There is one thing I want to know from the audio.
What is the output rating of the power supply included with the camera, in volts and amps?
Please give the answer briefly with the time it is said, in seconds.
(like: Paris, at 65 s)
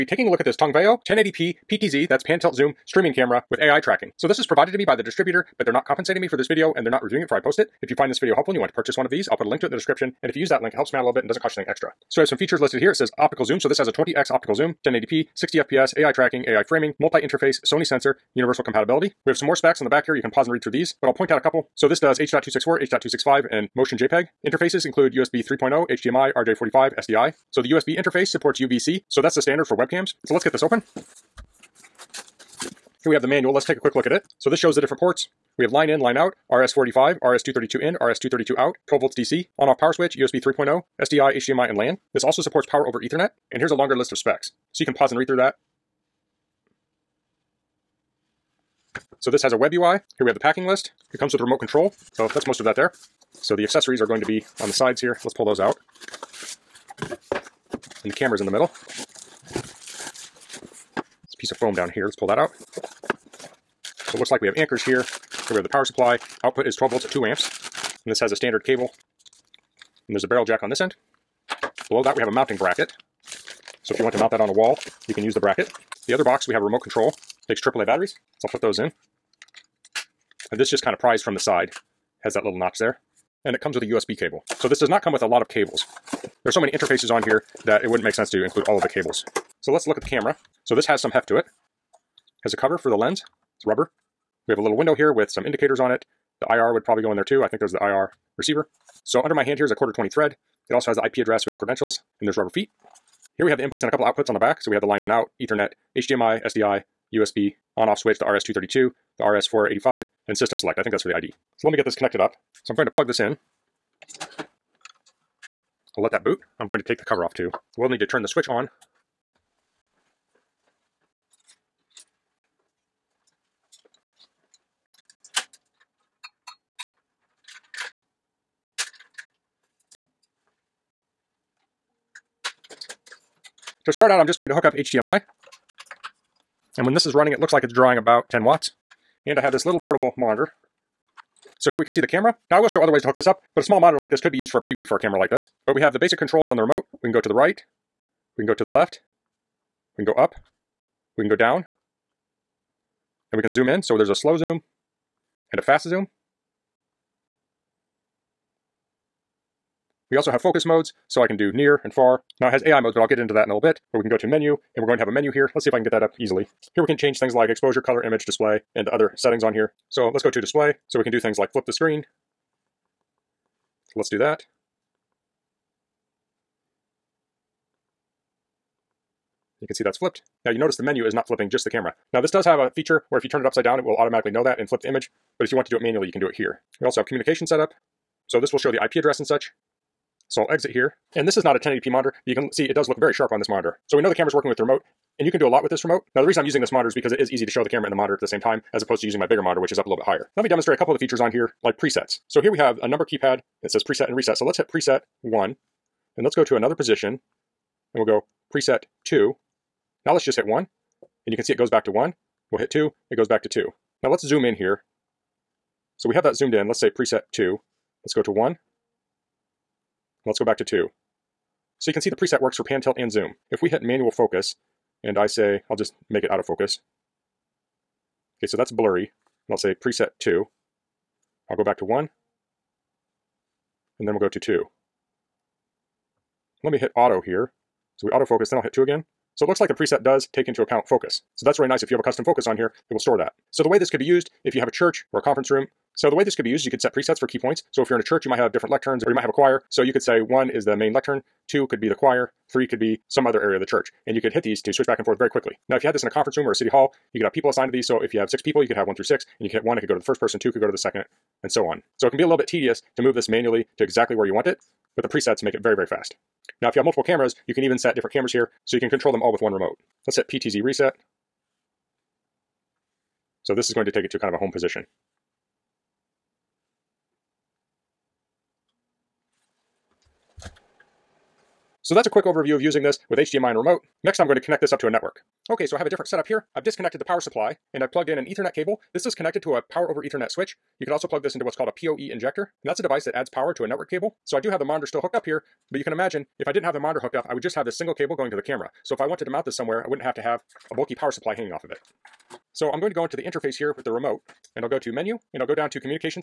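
12 volts at 2 amps, at 66 s.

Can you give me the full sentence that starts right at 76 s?
The other box we have a remote control takes AAA batteries, so I'll put those in.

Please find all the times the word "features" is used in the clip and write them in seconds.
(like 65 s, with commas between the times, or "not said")
12 s, 182 s, 200 s.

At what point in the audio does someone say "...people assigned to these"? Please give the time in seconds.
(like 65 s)
257 s.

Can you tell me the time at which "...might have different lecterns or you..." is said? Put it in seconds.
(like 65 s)
248 s.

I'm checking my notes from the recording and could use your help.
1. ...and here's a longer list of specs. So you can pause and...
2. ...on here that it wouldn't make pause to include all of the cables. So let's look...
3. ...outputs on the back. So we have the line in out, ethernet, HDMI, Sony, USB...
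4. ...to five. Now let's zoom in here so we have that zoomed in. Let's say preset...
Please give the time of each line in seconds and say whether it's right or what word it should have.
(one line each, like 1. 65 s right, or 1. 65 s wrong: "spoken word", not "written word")
1. 43 s right
2. 87 s wrong: "sense", not "pause"
3. 104 s wrong: "SDI", not "Sony"
4. 213 s wrong: "two", not "five".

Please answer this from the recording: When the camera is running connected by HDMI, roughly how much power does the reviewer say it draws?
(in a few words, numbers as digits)
10 watts.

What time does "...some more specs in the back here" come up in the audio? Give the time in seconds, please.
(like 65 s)
19 s.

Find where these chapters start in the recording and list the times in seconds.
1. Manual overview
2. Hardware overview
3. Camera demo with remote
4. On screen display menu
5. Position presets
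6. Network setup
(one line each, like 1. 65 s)
1. 32 s
2. 89 s
3. 133 s
4. 163 s
5. 199 s
6. 285 s.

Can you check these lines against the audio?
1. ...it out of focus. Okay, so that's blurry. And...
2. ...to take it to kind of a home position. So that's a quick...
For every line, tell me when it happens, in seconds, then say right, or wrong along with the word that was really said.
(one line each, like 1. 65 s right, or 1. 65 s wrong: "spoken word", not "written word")
1. 226 s right
2. 273 s right.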